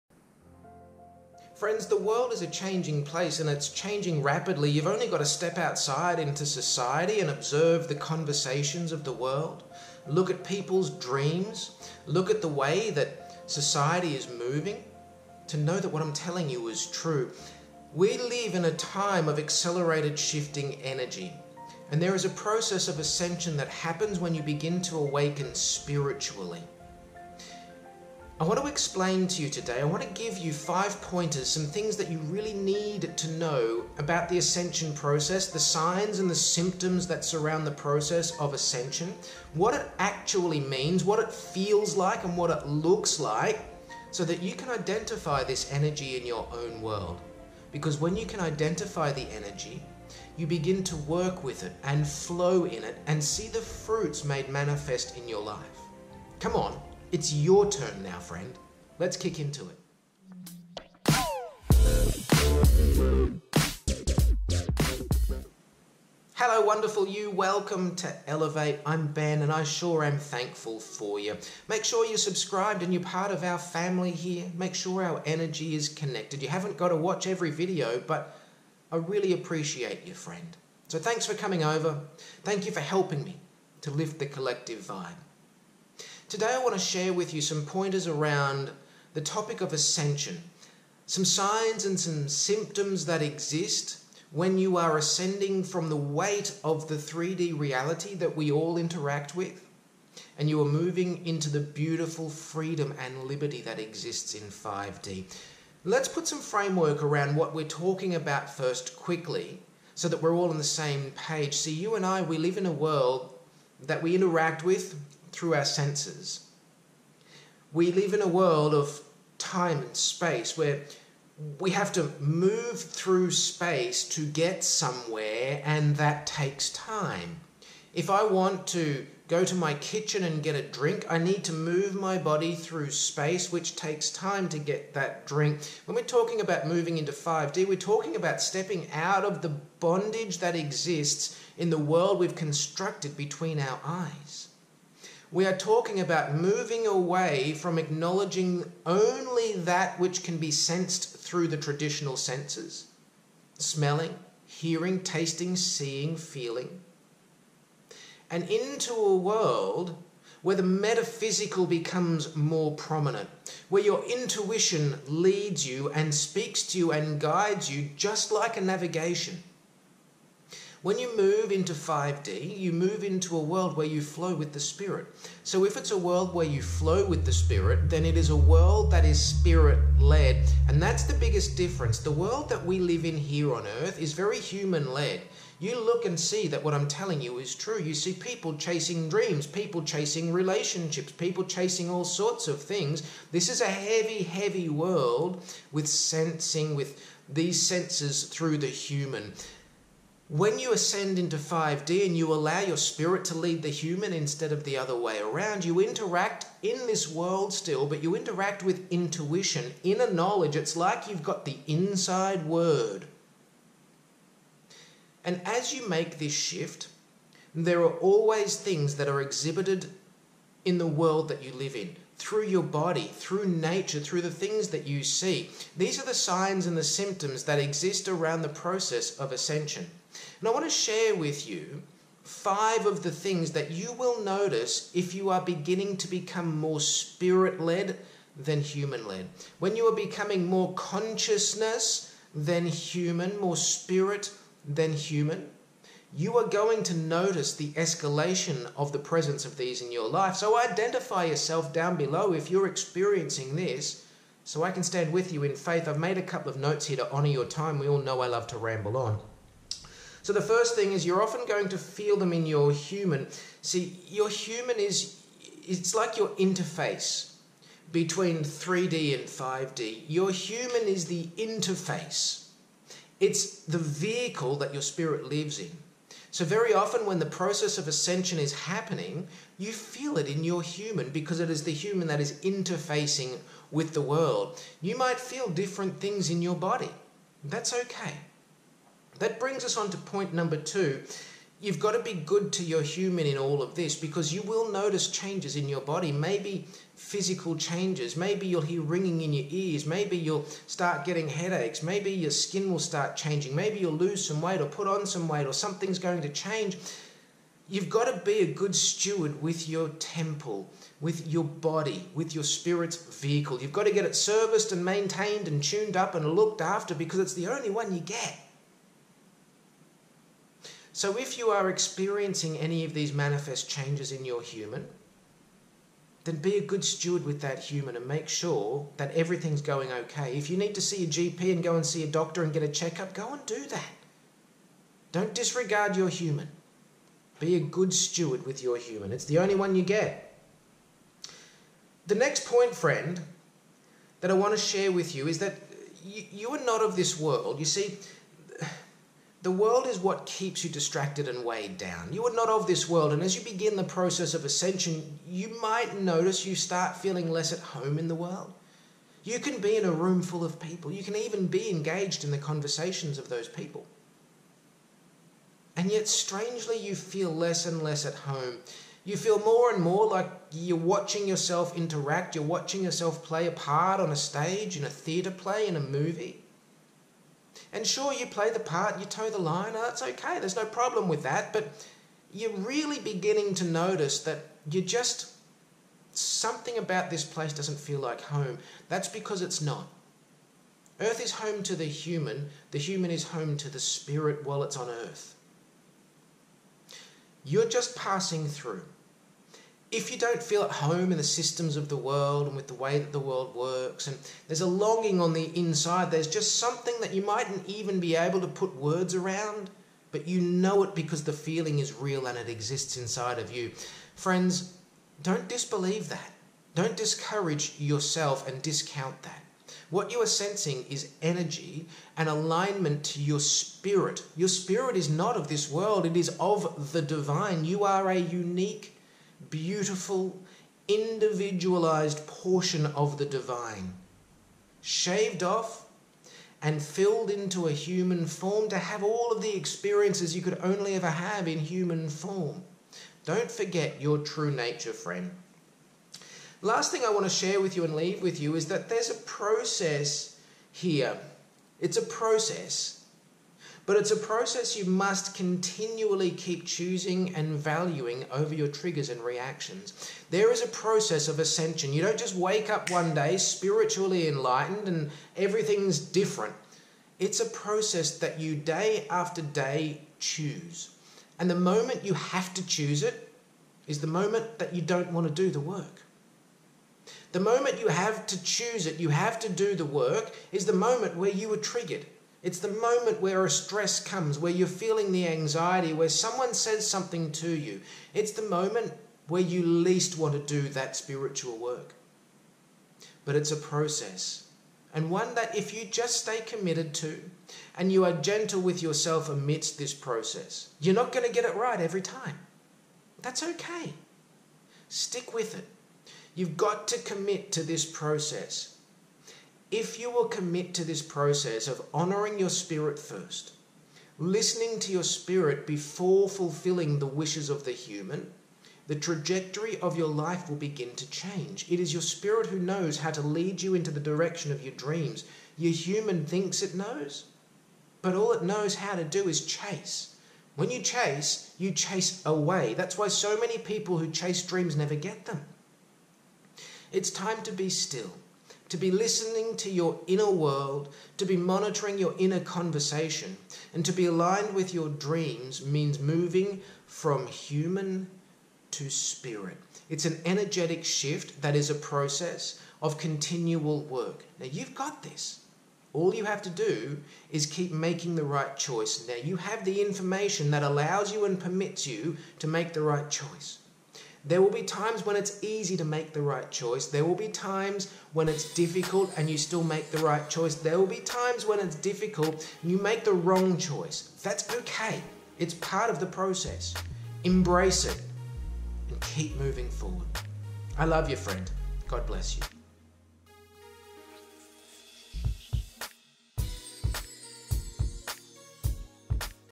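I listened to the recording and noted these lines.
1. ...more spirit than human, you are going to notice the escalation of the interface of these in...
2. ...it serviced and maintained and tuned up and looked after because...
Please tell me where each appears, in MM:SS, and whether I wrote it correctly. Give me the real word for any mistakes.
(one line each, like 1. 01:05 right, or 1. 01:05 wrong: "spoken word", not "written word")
1. 04:03 wrong: "presence", not "interface"
2. 05:14 right.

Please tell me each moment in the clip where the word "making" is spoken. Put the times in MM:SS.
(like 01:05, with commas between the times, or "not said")
09:17.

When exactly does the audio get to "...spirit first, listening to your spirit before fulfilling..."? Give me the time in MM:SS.
08:32.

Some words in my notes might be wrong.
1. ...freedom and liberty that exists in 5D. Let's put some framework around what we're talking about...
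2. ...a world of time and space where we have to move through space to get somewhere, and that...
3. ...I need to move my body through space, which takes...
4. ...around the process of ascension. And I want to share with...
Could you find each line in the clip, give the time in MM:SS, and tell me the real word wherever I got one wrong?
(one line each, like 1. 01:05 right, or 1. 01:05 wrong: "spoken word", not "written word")
1. 01:42 right
2. 01:58 right
3. 02:11 right
4. 03:48 right.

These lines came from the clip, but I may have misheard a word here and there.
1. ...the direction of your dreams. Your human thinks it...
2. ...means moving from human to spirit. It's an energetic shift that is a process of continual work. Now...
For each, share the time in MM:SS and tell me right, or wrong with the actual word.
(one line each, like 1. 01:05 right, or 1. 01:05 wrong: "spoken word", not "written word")
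1. 08:43 right
2. 09:05 right.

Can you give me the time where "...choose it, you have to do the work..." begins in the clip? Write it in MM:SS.
07:58.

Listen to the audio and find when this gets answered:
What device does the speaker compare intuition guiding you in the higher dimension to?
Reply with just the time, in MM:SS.
02:48.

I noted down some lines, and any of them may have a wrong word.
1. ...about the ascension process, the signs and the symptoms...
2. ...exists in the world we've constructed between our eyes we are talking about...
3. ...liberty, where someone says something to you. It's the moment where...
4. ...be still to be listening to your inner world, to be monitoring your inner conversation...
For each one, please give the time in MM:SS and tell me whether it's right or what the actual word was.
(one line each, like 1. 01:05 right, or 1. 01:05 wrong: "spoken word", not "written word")
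1. 00:33 right
2. 02:20 right
3. 08:05 wrong: "anxiety", not "liberty"
4. 08:57 right.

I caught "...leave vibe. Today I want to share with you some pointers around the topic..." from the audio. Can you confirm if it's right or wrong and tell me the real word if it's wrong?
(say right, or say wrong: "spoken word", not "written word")
wrong: "collective", not "leave".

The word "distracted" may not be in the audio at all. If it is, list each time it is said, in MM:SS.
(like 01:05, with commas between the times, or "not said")
05:50.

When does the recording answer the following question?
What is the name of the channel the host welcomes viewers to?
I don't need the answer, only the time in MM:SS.
01:08.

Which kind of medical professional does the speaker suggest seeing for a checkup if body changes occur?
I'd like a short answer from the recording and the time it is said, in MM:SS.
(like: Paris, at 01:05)
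A GP, at 05:31.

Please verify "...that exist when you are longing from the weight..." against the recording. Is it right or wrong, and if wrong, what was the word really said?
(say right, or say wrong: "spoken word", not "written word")
wrong: "ascending", not "longing".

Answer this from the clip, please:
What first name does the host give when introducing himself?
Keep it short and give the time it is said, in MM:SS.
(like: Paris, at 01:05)
Ben, at 01:09.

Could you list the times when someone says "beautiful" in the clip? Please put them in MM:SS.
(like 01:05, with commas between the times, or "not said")
01:41, 07:09.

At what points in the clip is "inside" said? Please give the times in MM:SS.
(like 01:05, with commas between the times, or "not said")
03:31, 06:45, 06:52.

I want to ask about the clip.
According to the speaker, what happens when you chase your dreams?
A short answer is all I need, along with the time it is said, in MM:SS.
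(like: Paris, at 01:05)
You chase away, at 08:51.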